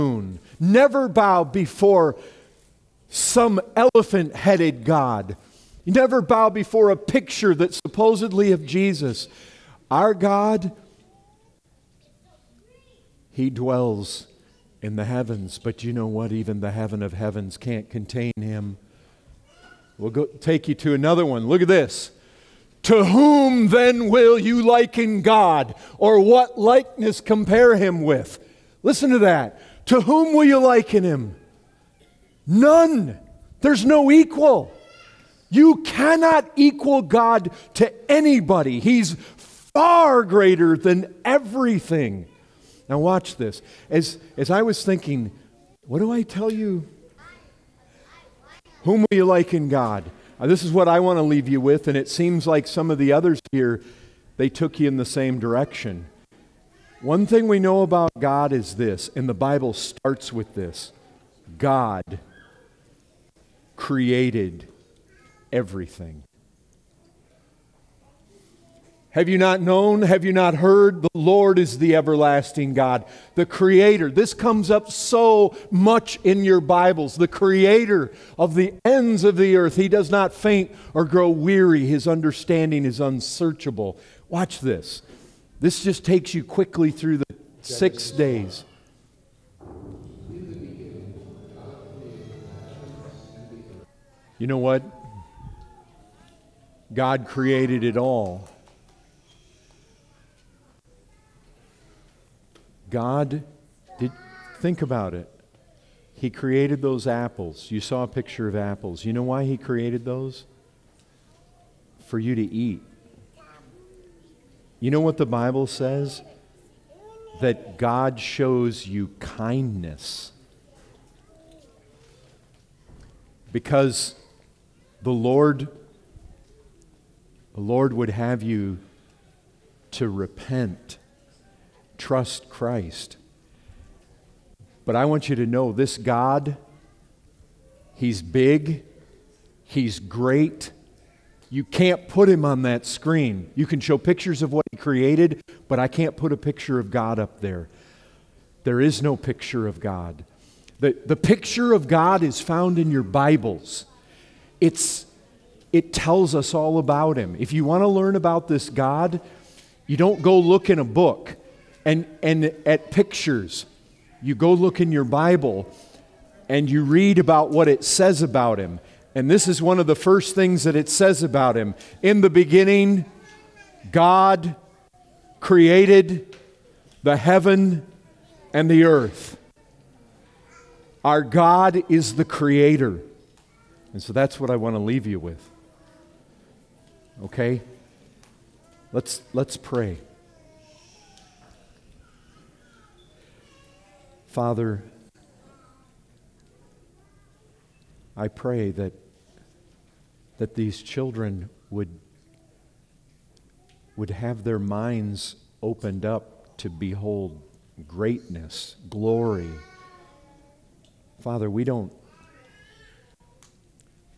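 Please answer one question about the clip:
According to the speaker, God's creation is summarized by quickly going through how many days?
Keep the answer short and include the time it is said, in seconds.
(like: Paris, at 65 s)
6, at 87 s.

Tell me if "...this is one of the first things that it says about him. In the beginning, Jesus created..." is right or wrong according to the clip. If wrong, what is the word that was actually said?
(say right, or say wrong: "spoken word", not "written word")
wrong: "God", not "Jesus".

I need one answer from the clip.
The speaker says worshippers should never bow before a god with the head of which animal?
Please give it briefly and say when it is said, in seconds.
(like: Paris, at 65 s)
elephant, at 3 s.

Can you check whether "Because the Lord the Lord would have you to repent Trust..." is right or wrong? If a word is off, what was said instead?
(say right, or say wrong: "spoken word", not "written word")
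right.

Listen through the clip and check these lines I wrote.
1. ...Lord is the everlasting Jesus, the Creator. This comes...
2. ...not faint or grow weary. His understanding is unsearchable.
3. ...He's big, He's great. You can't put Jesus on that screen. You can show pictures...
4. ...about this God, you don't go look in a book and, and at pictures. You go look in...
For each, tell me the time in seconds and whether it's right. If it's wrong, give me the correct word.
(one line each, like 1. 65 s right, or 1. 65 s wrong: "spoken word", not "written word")
1. 71 s wrong: "God", not "Jesus"
2. 80 s right
3. 137 s wrong: "Him", not "Jesus"
4. 158 s right.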